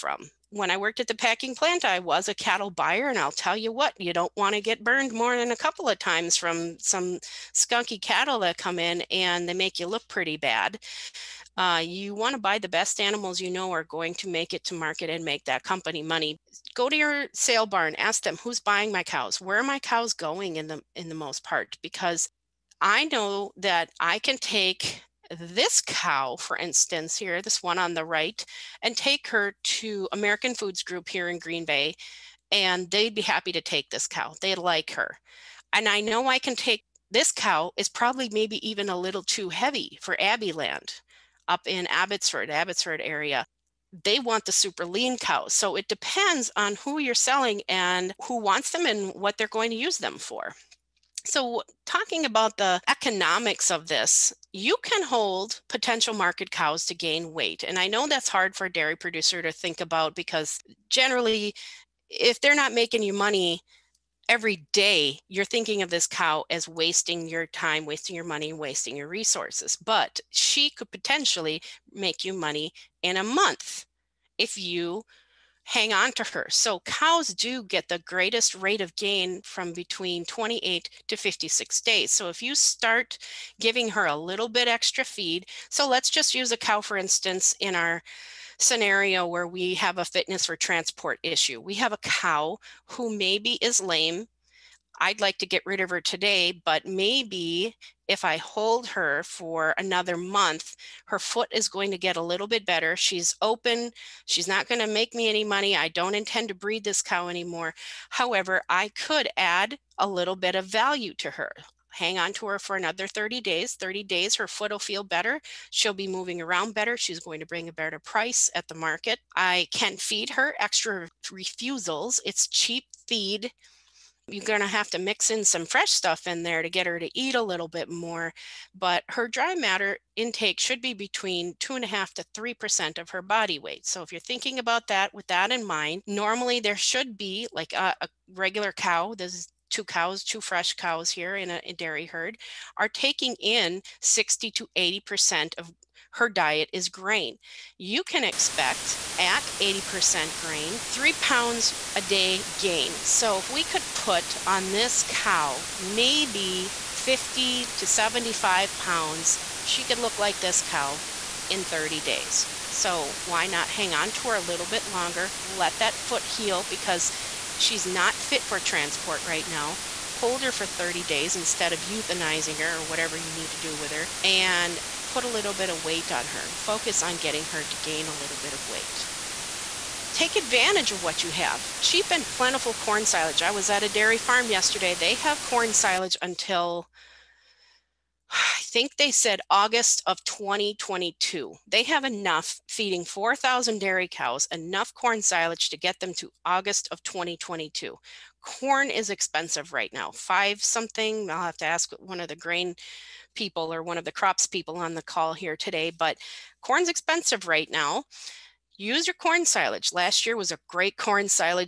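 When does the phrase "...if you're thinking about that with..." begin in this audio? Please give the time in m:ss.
2:14.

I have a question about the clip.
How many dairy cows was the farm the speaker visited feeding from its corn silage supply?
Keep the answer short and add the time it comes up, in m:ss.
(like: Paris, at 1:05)
4,000, at 3:13.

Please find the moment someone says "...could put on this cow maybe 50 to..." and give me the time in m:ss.
2:33.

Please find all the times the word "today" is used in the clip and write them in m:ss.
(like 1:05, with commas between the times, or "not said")
1:36, 3:25.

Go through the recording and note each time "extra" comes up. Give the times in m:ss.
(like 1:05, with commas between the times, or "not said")
1:24, 2:00.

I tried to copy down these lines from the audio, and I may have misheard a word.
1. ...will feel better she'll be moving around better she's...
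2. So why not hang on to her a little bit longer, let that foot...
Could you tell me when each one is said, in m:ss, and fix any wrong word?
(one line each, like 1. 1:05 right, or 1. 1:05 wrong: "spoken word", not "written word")
1. 1:54 right
2. 2:42 right.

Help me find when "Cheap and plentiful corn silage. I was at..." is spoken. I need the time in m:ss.
3:01.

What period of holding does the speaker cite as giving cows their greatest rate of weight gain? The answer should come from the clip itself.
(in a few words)
28 to 56 days.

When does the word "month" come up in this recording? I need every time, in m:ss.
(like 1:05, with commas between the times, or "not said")
1:13, 1:40.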